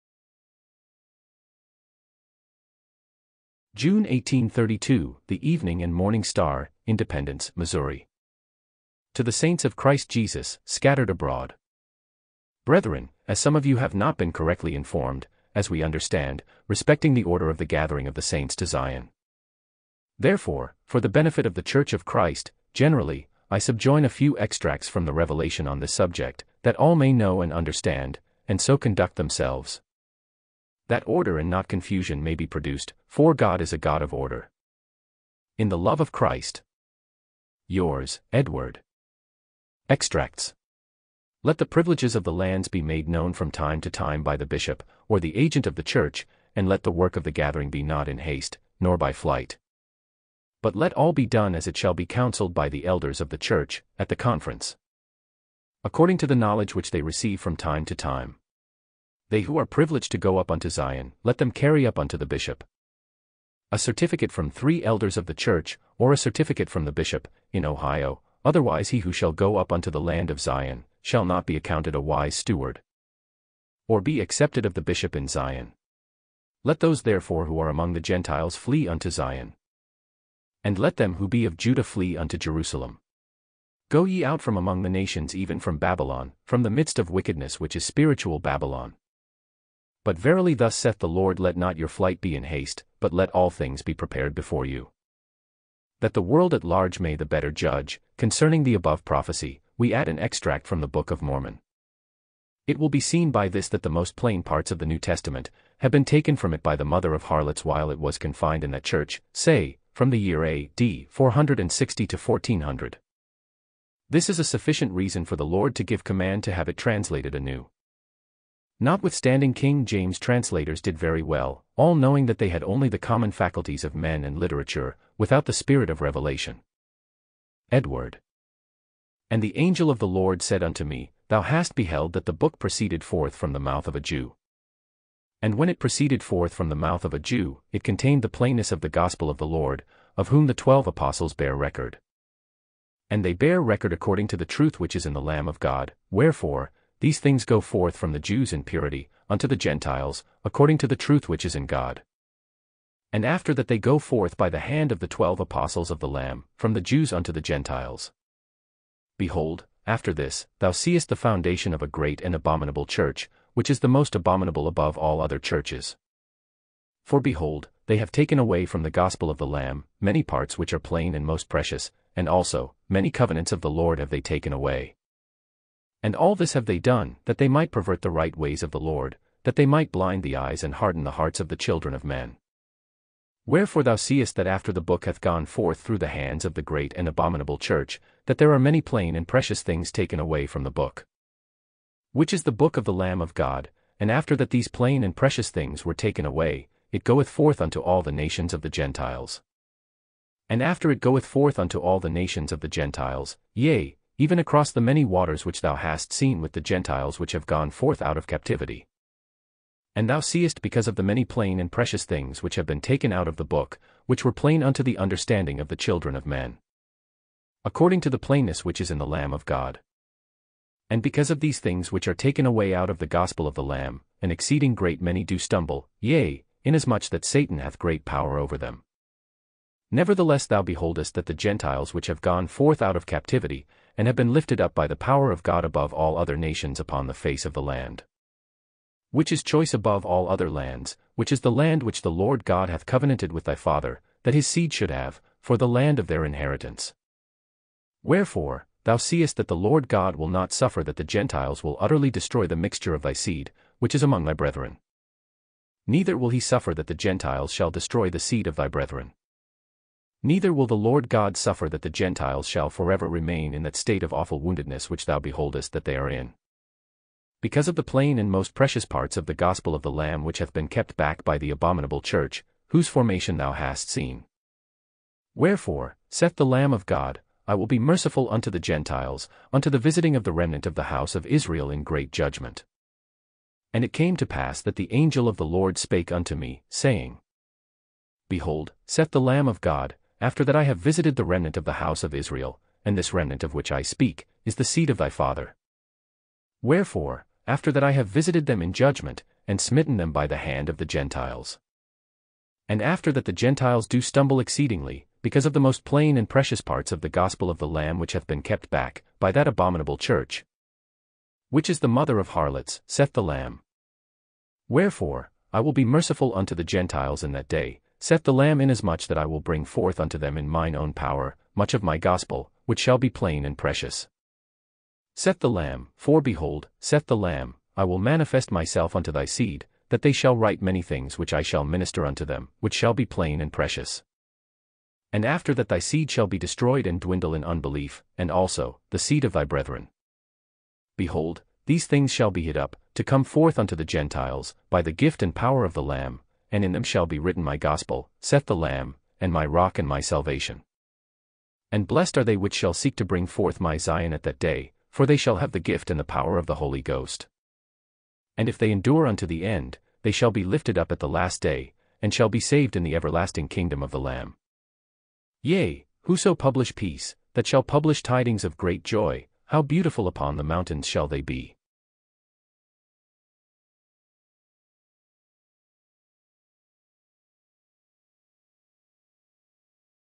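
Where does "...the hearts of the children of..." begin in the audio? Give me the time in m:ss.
3:01.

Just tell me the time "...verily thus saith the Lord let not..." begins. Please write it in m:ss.
1:30.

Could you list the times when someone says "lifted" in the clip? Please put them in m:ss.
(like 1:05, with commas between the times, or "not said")
3:54, 6:00.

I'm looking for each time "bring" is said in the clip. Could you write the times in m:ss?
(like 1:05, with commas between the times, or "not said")
5:19, 5:53.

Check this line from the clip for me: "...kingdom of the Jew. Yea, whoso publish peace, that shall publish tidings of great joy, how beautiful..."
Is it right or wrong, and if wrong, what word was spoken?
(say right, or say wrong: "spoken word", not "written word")
wrong: "Lamb", not "Jew".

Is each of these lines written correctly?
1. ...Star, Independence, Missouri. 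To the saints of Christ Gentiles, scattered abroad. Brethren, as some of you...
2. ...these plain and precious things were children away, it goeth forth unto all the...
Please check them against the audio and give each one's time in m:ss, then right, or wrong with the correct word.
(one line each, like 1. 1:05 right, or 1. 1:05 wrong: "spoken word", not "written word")
1. 0:06 wrong: "Jesus", not "Gentiles"
2. 3:14 wrong: "taken", not "children".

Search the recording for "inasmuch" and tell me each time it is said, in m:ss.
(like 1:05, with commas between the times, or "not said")
3:46, 5:18.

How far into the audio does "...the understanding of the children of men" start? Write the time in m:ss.
3:34.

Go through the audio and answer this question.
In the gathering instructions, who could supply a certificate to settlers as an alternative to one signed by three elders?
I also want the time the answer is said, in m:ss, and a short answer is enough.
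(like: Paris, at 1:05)
the bishop in Ohio, at 1:06.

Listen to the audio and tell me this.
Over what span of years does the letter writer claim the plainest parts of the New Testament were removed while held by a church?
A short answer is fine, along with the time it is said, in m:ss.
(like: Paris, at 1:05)
460 to 1400, at 1:51.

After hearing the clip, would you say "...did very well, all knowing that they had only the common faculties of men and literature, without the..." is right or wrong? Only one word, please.
right.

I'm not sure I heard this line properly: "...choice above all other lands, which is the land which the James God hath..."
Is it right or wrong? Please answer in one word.
wrong.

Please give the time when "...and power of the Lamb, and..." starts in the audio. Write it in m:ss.
5:45.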